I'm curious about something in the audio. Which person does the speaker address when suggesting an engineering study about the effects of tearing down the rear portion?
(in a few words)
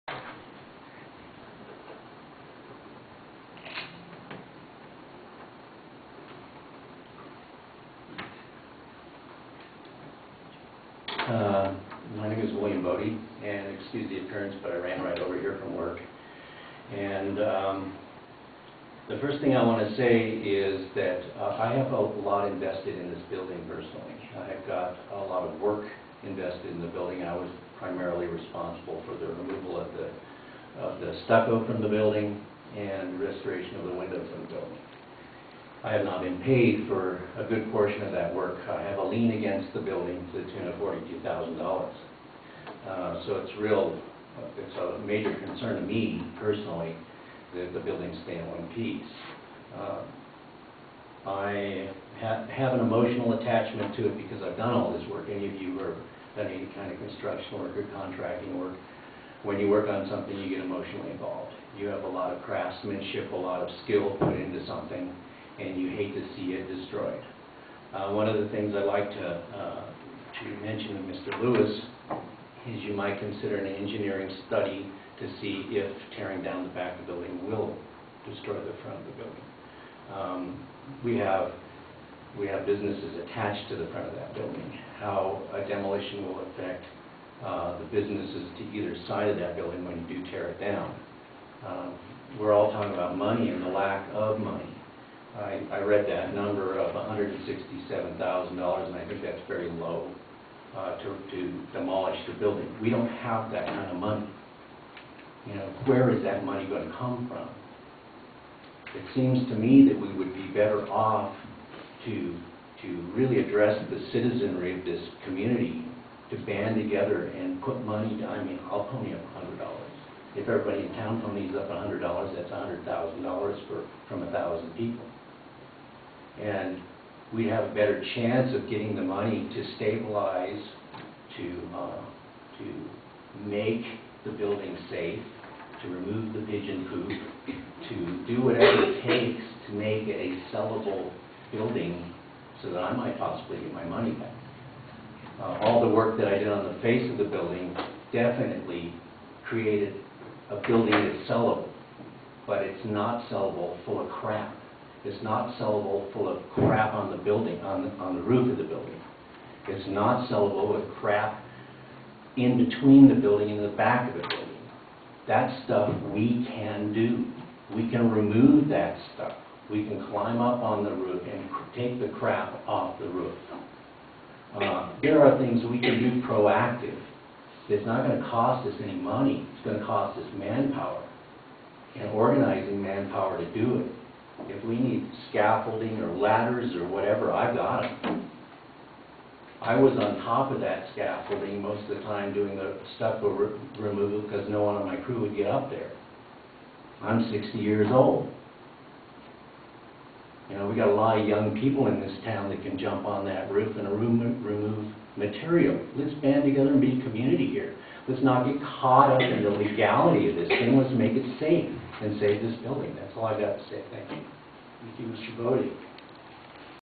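Mr. Lewis.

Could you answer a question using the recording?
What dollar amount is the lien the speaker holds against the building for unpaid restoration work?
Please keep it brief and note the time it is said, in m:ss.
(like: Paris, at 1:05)
$42,000, at 0:40.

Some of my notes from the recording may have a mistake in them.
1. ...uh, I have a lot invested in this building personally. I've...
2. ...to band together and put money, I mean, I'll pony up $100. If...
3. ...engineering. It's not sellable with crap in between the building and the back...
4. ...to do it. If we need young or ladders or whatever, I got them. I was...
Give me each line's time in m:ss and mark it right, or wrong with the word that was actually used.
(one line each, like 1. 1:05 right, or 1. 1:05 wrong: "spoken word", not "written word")
1. 0:21 right
2. 1:56 right
3. 2:38 wrong: "building", not "engineering"
4. 3:03 wrong: "scaffolding", not "young".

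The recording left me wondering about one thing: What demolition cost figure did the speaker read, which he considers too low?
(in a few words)
$167,000.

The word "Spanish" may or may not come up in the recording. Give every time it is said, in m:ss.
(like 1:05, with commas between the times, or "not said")
not said.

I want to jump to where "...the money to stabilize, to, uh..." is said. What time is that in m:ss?
2:08.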